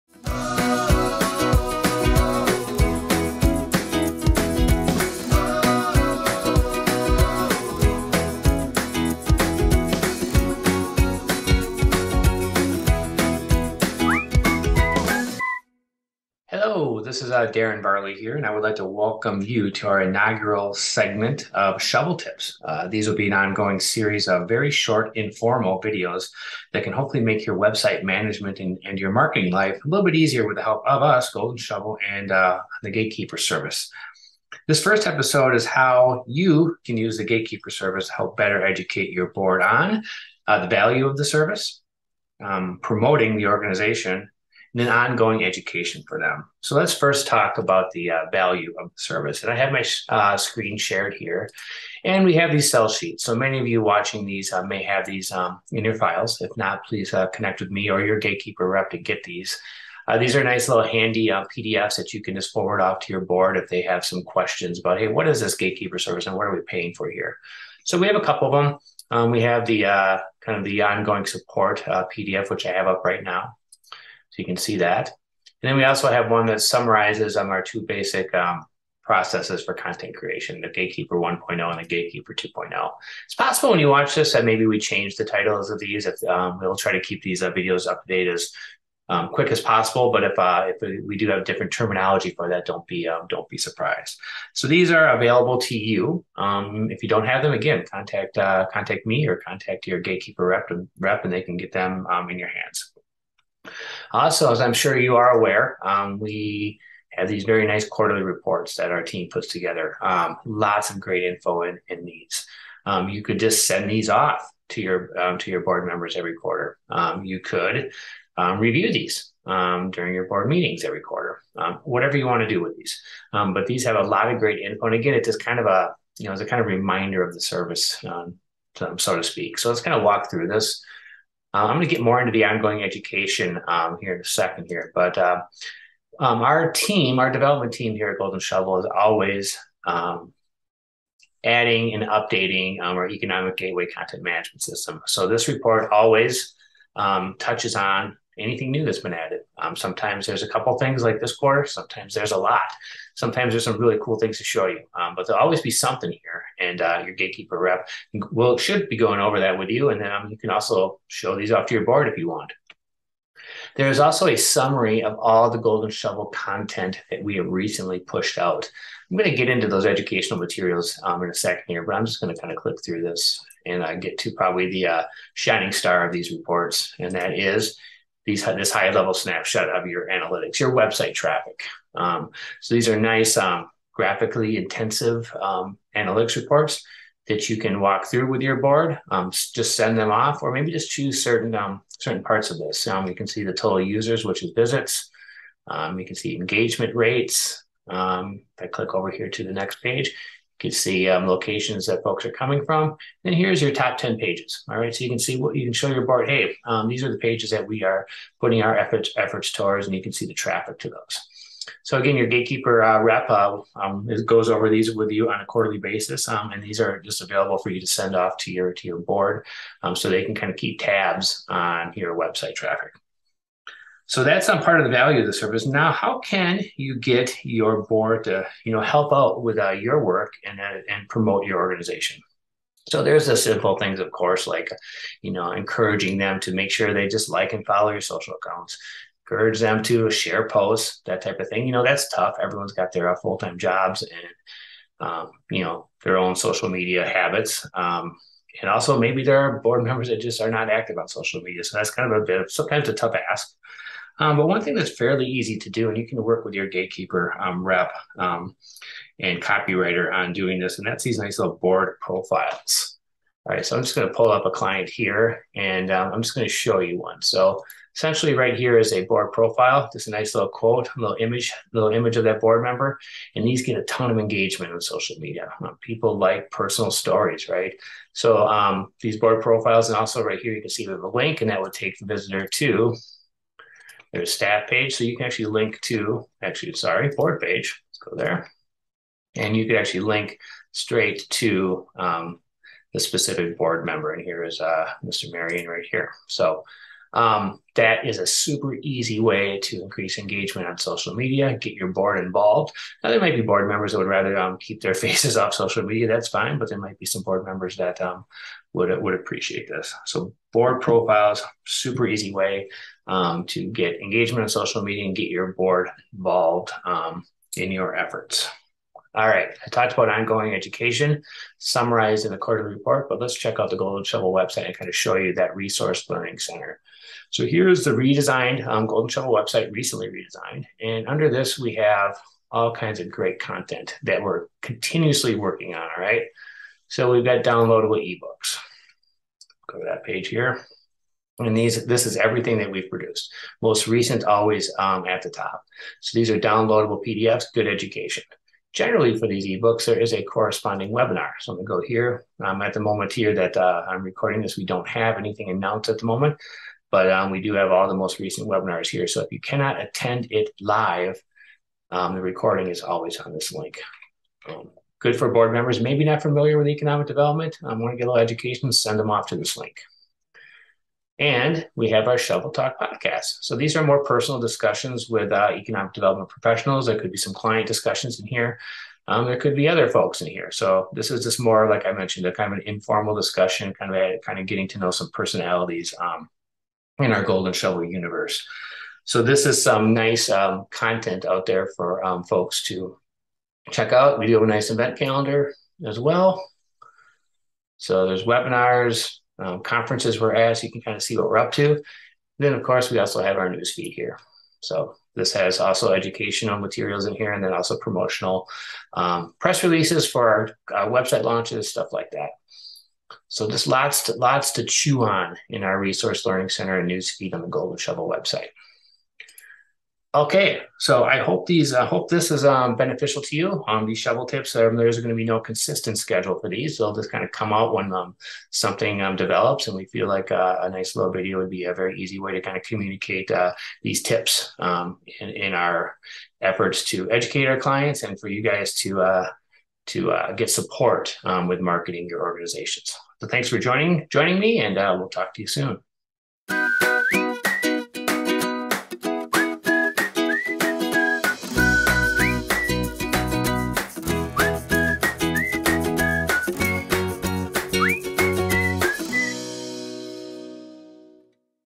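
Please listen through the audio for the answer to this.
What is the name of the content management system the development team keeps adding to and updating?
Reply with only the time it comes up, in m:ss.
2:23.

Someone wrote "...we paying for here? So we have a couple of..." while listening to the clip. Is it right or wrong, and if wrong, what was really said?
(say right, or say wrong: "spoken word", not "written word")
right.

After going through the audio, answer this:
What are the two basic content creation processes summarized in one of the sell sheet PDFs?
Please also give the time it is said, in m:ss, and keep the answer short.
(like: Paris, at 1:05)
Gatekeeper 1.0 and Gatekeeper 2.0, at 1:20.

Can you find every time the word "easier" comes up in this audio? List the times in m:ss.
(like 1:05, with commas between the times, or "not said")
0:30.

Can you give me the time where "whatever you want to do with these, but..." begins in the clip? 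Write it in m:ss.
2:01.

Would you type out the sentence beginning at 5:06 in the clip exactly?
That's fine, but there might be some board members that um, would, would appreciate this.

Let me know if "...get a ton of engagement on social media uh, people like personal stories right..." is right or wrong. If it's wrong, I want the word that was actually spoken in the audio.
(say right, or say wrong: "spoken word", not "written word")
right.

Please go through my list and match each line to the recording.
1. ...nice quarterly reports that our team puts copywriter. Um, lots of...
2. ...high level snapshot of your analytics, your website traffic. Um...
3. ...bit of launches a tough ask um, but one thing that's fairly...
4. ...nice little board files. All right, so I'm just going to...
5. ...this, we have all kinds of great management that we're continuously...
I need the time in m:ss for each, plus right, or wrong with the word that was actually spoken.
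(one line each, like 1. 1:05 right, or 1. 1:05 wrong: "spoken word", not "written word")
1. 1:47 wrong: "together", not "copywriter"
2. 2:58 right
3. 4:12 wrong: "sometimes", not "launches"
4. 4:21 wrong: "profiles", not "files"
5. 5:31 wrong: "content", not "management".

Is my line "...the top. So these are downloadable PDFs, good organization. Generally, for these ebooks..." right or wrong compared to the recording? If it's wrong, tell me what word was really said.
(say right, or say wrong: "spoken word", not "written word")
wrong: "education", not "organization".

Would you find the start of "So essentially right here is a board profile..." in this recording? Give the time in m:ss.
4:27.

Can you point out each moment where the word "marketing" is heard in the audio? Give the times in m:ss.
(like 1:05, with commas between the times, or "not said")
0:29, 7:21.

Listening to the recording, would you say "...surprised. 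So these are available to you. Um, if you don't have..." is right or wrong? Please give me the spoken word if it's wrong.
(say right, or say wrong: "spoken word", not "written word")
right.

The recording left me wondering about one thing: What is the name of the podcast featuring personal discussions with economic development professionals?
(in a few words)
Shovel Talk.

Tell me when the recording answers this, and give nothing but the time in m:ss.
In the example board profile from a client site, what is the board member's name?
4:55.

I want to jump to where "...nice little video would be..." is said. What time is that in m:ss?
7:10.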